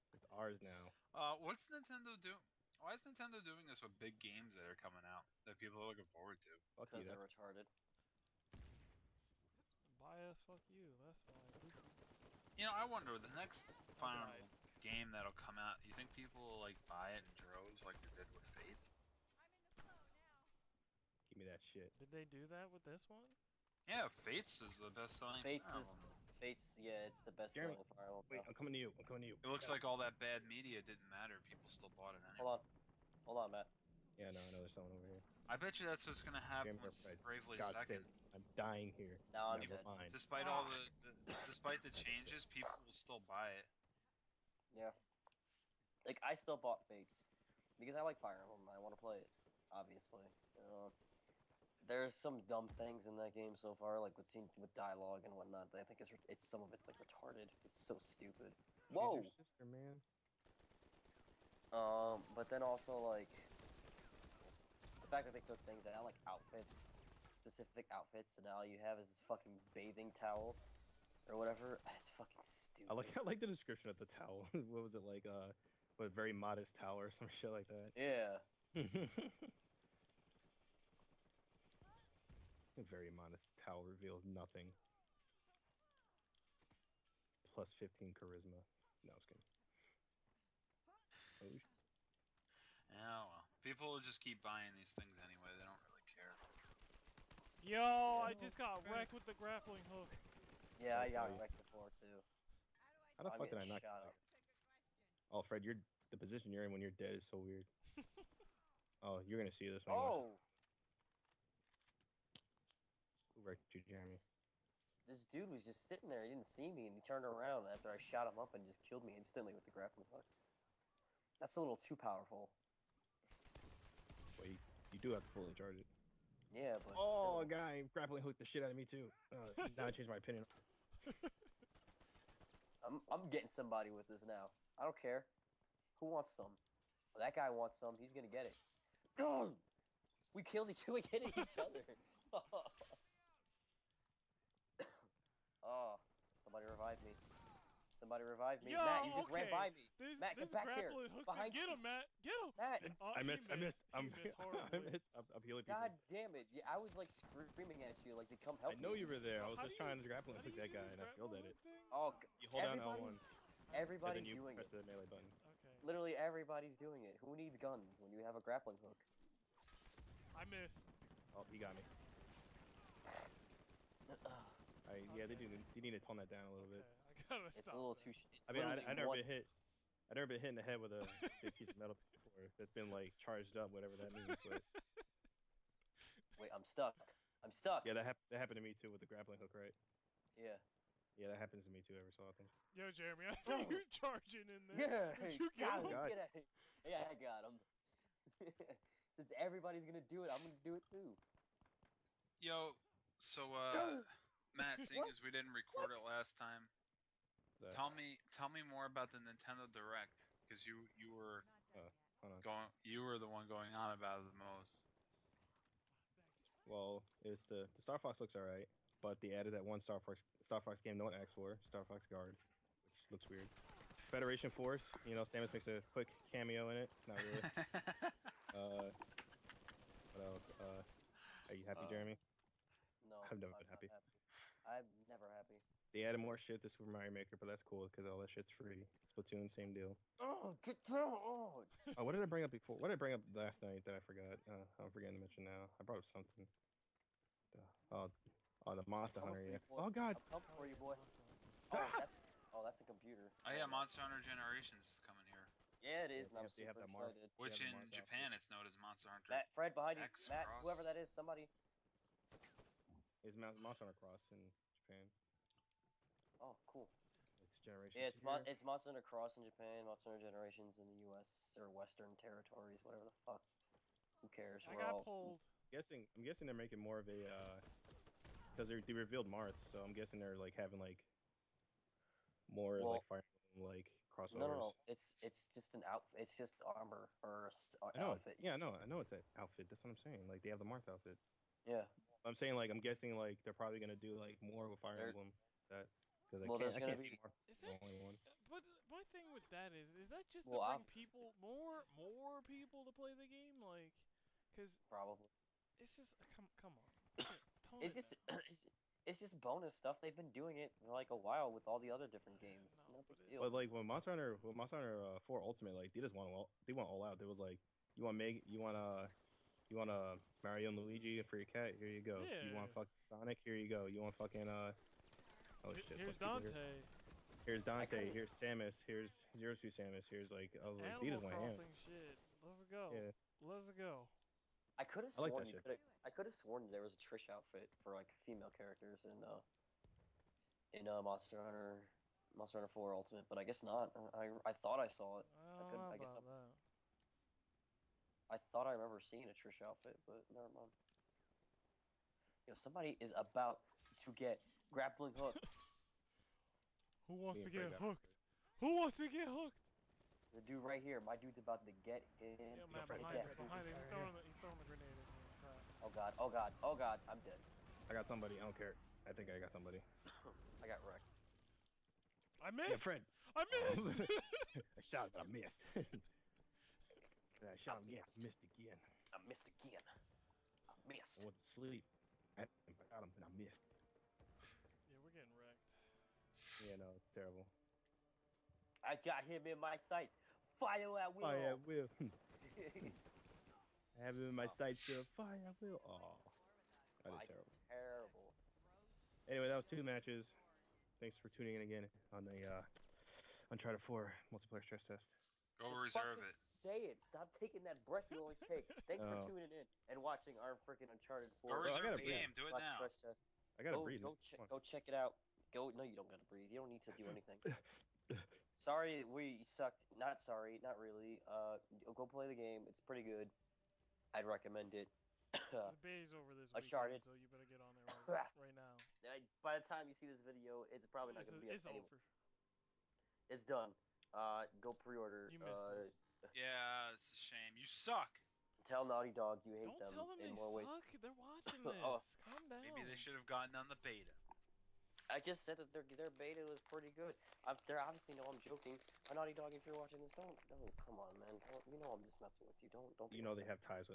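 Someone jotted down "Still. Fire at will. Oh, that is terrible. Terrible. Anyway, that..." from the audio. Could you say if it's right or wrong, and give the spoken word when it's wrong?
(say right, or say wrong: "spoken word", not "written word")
right.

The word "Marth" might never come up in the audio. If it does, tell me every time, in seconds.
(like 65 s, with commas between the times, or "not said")
279 s, 290 s.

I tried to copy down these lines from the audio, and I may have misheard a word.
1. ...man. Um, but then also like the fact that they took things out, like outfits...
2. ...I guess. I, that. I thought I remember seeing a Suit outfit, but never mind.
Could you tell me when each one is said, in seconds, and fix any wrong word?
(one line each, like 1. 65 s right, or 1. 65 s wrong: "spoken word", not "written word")
1. 59 s right
2. 345 s wrong: "Trish", not "Suit".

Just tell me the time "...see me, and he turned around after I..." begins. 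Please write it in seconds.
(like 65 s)
116 s.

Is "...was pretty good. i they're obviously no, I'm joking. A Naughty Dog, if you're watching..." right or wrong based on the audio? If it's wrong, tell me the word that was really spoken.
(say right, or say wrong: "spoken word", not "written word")
right.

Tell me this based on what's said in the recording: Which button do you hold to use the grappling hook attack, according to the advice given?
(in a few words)
L1.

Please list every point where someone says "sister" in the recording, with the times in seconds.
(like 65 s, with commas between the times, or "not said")
59 s.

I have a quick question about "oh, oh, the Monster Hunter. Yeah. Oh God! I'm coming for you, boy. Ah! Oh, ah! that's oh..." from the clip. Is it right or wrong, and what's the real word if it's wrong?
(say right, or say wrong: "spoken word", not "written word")
right.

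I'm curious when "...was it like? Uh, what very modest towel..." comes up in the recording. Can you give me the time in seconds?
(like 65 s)
74 s.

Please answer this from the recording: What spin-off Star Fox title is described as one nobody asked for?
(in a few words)
Star Fox Guard.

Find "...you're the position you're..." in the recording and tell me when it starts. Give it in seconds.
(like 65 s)
105 s.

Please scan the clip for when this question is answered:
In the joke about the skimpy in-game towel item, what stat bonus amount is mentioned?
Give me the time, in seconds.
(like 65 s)
87 s.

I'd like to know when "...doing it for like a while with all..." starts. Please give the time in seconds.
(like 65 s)
310 s.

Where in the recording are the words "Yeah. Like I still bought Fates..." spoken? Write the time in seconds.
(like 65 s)
44 s.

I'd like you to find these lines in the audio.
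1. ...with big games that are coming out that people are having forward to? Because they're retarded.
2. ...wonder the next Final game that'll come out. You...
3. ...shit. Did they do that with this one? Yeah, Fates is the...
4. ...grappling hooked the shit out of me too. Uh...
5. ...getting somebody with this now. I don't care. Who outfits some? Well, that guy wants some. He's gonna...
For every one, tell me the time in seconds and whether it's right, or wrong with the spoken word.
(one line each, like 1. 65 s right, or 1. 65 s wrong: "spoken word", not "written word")
1. 3 s wrong: "looking", not "having"
2. 12 s right
3. 21 s right
4. 127 s right
5. 133 s wrong: "wants", not "outfits".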